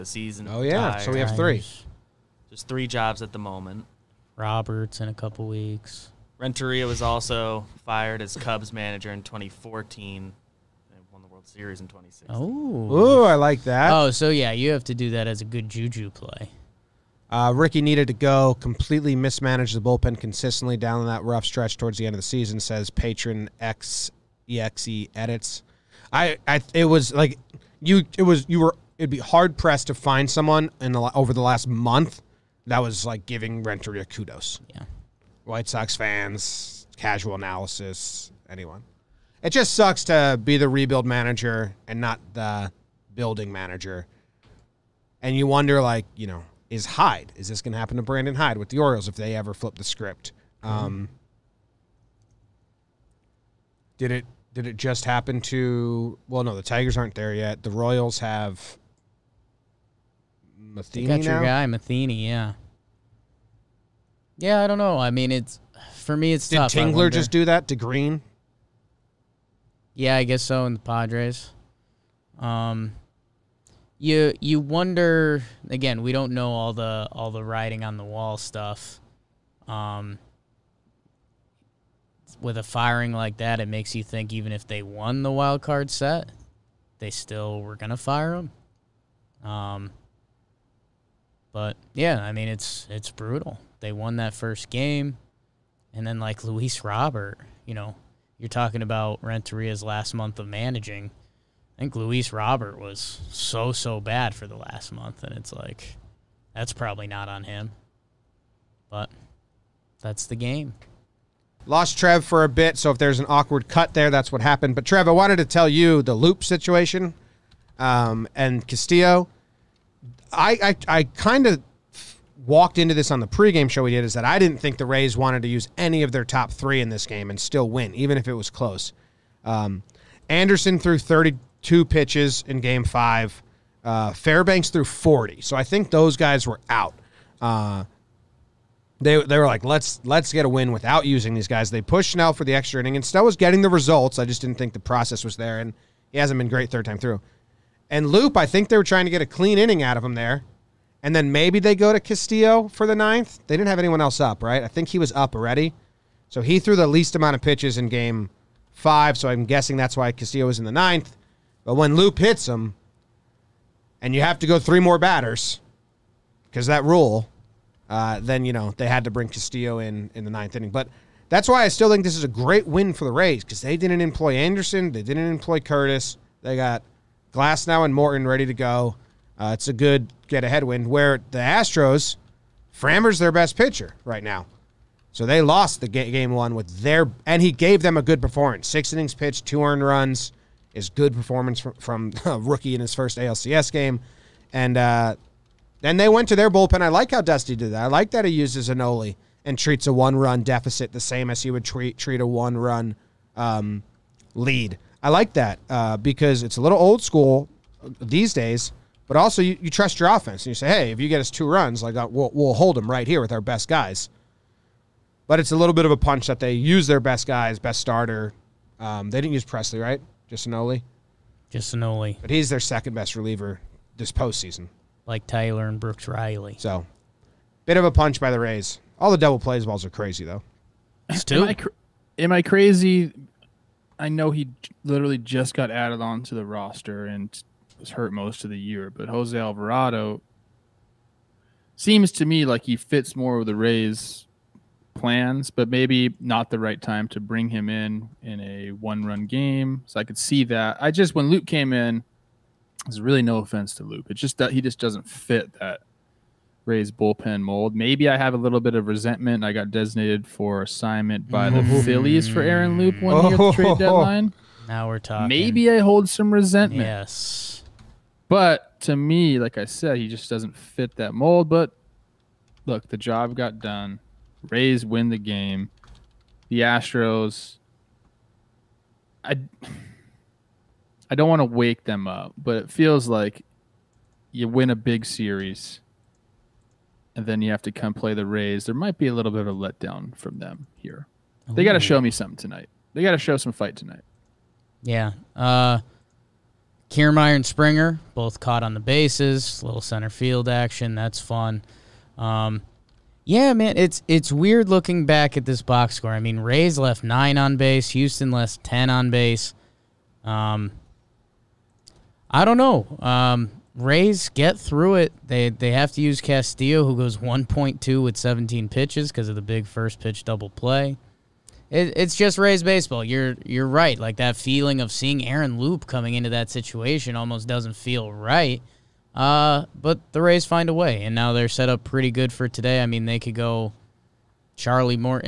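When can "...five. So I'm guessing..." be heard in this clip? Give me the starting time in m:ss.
2:38.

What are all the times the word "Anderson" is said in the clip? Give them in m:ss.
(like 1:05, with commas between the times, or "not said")
2:10, 2:54.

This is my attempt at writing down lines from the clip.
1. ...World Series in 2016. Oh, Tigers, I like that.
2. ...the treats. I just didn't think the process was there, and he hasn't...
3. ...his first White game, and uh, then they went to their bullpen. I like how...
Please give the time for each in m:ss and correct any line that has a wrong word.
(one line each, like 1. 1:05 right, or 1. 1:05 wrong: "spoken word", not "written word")
1. 0:11 wrong: "Ooh", not "Tigers"
2. 2:23 wrong: "results", not "treats"
3. 3:12 wrong: "ALCS", not "White".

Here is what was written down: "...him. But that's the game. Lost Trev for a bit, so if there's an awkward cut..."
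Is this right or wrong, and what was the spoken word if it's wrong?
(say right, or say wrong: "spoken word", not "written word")
right.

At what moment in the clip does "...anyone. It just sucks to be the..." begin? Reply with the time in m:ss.
0:38.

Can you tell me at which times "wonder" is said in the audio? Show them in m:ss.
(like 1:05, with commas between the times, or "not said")
0:45, 1:14.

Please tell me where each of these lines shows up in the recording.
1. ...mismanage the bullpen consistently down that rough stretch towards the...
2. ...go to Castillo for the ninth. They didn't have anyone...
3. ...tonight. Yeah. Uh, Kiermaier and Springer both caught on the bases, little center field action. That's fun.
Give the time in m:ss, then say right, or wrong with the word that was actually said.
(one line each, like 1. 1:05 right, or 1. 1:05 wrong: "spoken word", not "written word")
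1. 0:19 right
2. 2:31 right
3. 4:53 right.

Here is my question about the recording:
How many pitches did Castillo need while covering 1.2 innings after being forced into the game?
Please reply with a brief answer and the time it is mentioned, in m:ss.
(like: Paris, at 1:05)
17, at 5:18.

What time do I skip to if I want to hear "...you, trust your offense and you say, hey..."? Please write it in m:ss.
3:29.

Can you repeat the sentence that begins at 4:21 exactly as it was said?
Phillies for Aaron Loup one year at trade oh.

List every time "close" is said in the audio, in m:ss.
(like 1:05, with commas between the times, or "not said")
2:08.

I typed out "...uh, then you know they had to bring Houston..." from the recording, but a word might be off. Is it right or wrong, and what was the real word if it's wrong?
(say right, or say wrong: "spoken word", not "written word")
wrong: "Castillo", not "Houston".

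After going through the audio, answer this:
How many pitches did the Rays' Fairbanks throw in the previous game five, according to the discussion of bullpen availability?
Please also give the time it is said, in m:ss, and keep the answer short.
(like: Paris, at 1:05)
40, at 2:14.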